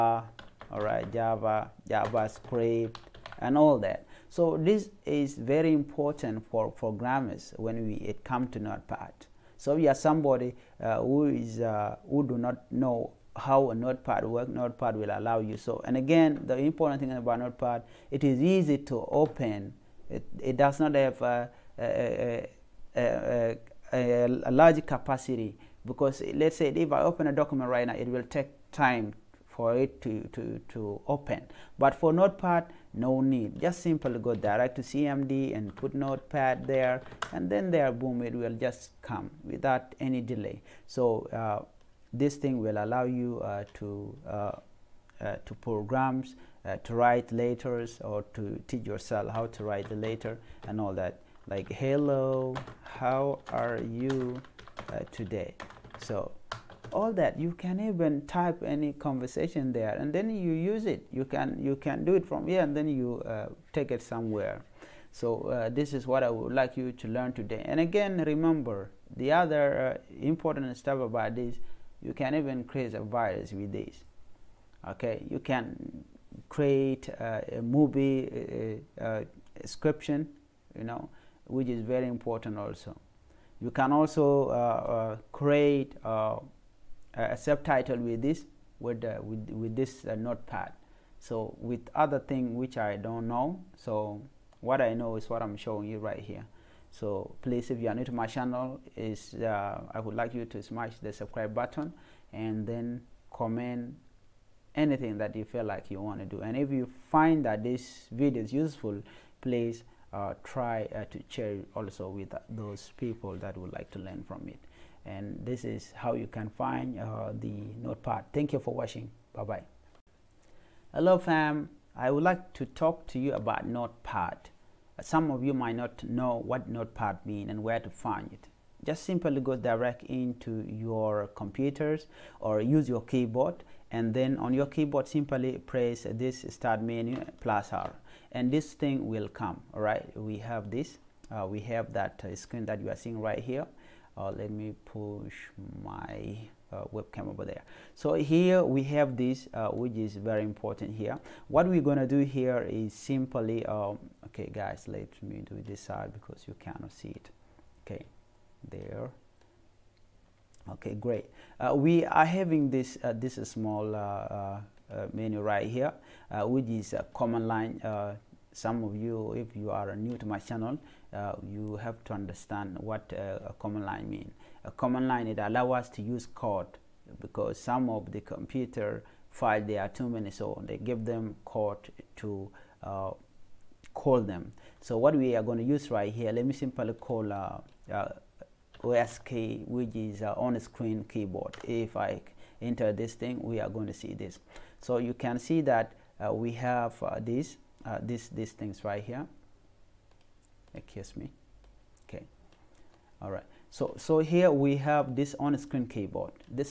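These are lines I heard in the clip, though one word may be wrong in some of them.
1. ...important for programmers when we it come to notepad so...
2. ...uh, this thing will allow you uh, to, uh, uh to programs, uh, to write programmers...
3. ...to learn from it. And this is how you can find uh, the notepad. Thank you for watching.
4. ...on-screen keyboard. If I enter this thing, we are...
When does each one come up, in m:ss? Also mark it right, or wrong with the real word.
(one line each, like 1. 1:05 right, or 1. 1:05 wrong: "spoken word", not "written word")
1. 0:05 right
2. 0:41 wrong: "letters", not "programmers"
3. 1:53 right
4. 3:10 right.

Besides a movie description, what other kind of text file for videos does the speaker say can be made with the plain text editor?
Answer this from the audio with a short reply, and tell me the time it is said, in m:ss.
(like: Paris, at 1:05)
A subtitle, at 1:27.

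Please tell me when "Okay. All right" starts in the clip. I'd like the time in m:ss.
3:22.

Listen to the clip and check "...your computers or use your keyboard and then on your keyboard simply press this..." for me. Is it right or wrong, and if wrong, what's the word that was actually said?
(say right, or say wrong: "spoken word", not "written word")
right.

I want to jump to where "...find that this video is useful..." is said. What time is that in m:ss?
1:47.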